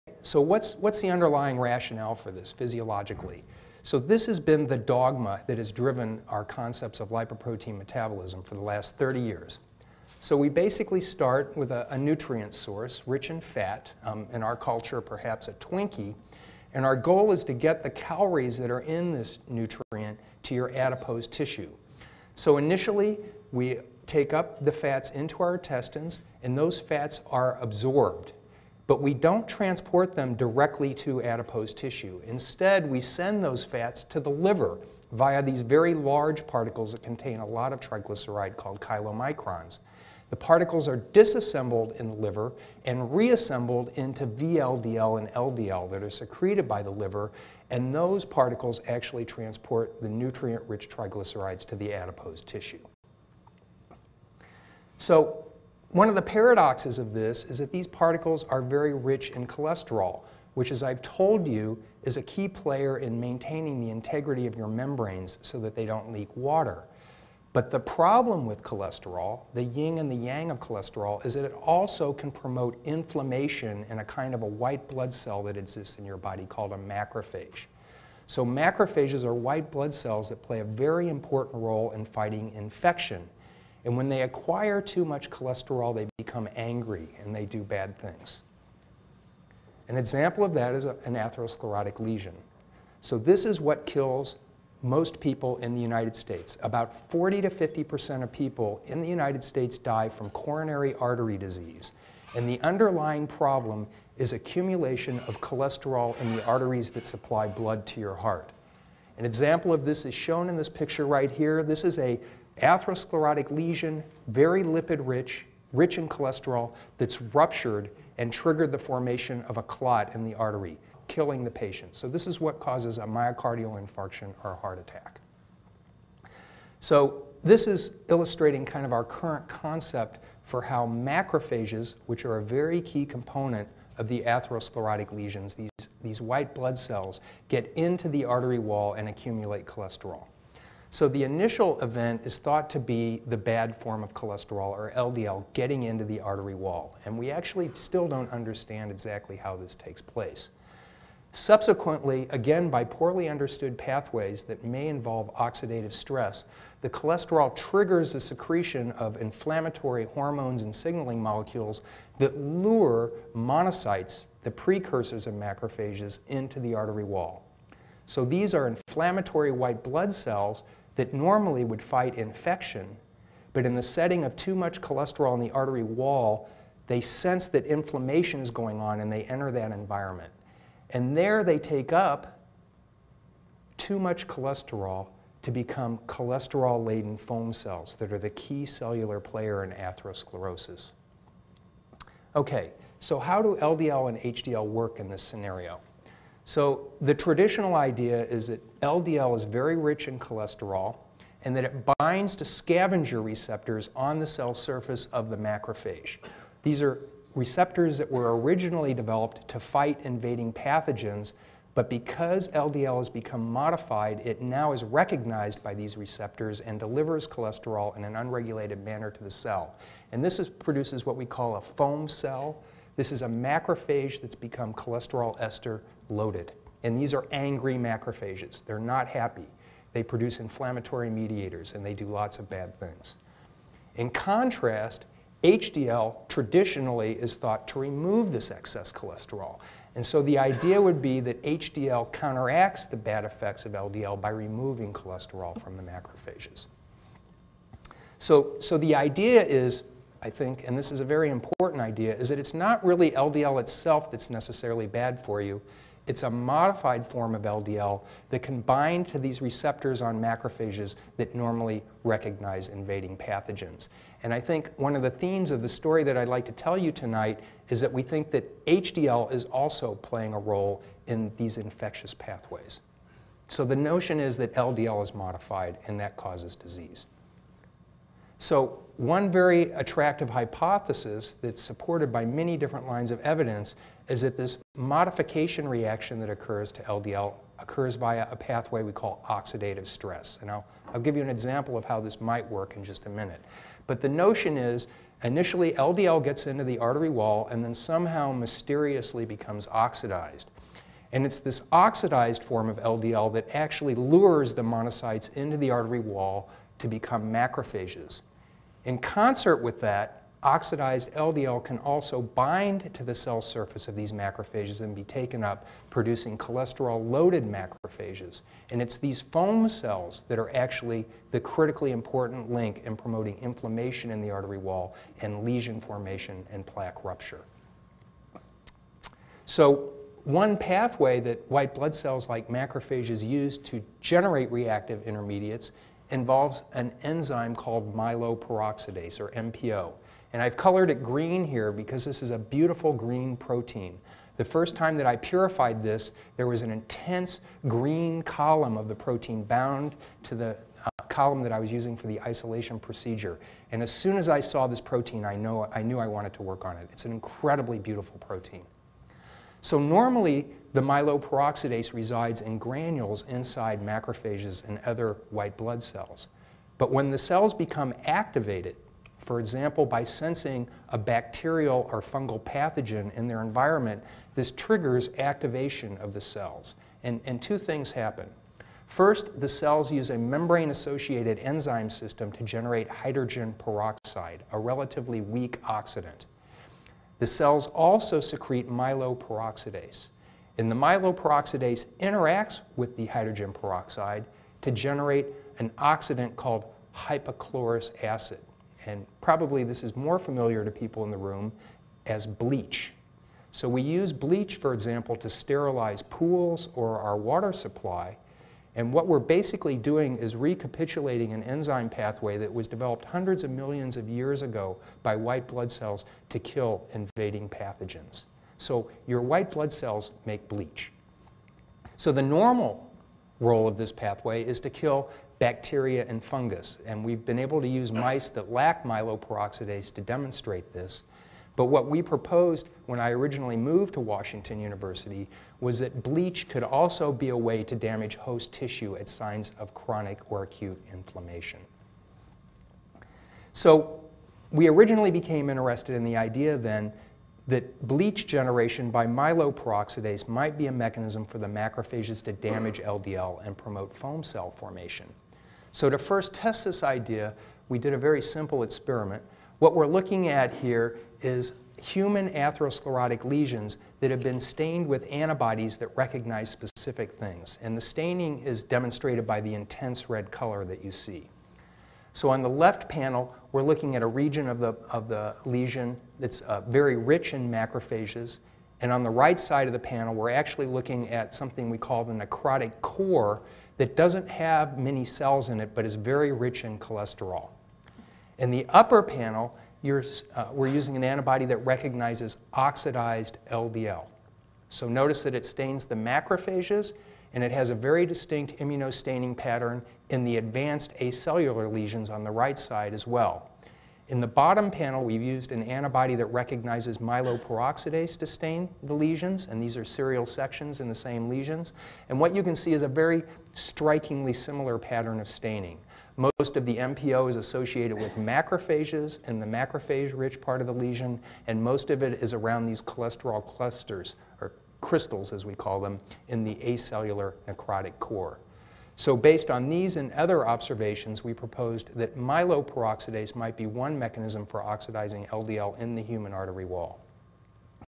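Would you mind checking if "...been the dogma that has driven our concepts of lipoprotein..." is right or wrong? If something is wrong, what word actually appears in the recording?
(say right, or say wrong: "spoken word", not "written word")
right.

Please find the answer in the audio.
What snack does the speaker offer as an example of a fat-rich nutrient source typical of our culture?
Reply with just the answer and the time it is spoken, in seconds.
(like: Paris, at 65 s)
Twinkie, at 15 s.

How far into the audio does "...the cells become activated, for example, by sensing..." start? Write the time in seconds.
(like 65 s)
367 s.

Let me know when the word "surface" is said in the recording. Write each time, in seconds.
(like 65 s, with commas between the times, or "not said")
204 s, 313 s.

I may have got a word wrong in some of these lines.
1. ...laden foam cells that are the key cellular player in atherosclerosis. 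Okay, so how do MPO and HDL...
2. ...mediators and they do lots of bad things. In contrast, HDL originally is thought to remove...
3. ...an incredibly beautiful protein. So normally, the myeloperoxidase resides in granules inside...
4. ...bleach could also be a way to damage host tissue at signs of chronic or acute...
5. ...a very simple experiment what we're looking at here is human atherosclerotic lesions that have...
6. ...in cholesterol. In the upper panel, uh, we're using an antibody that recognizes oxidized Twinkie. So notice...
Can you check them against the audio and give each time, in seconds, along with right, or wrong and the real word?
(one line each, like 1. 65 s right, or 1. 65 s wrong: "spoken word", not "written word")
1. 186 s wrong: "LDL", not "MPO"
2. 231 s wrong: "traditionally", not "originally"
3. 357 s right
4. 436 s right
5. 457 s right
6. 486 s wrong: "LDL", not "Twinkie".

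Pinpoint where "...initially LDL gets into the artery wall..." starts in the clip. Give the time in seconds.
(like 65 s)
295 s.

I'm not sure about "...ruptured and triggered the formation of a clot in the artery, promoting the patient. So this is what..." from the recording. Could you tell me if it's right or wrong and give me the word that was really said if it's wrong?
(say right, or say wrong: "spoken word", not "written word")
wrong: "killing", not "promoting".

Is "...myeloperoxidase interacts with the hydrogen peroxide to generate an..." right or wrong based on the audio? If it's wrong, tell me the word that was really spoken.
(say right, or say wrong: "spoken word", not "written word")
right.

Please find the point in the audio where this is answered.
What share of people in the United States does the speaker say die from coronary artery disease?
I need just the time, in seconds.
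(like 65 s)
97 s.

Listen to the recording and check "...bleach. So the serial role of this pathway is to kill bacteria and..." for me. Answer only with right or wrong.
wrong.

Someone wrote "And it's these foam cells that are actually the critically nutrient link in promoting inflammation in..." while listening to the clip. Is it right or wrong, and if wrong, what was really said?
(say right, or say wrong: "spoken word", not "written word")
wrong: "important", not "nutrient".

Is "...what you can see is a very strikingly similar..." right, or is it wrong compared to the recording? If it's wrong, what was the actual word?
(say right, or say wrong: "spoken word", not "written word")
right.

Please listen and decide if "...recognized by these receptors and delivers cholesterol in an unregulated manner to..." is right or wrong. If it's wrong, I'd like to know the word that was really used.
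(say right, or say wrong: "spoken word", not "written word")
right.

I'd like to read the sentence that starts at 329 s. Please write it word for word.
So one pathway that white blood cells like macrophages use to generate reactive intermediates involves an enzyme called myeloperoxidase, or MPO.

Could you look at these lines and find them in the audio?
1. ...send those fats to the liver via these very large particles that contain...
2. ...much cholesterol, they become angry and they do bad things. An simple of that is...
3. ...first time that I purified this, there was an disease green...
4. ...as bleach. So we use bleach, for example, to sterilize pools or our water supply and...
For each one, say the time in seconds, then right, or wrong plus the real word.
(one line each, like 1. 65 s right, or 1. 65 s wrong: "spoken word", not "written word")
1. 32 s right
2. 85 s wrong: "example", not "simple"
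3. 344 s wrong: "intense", not "disease"
4. 402 s right.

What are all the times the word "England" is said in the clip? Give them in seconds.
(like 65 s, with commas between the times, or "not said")
not said.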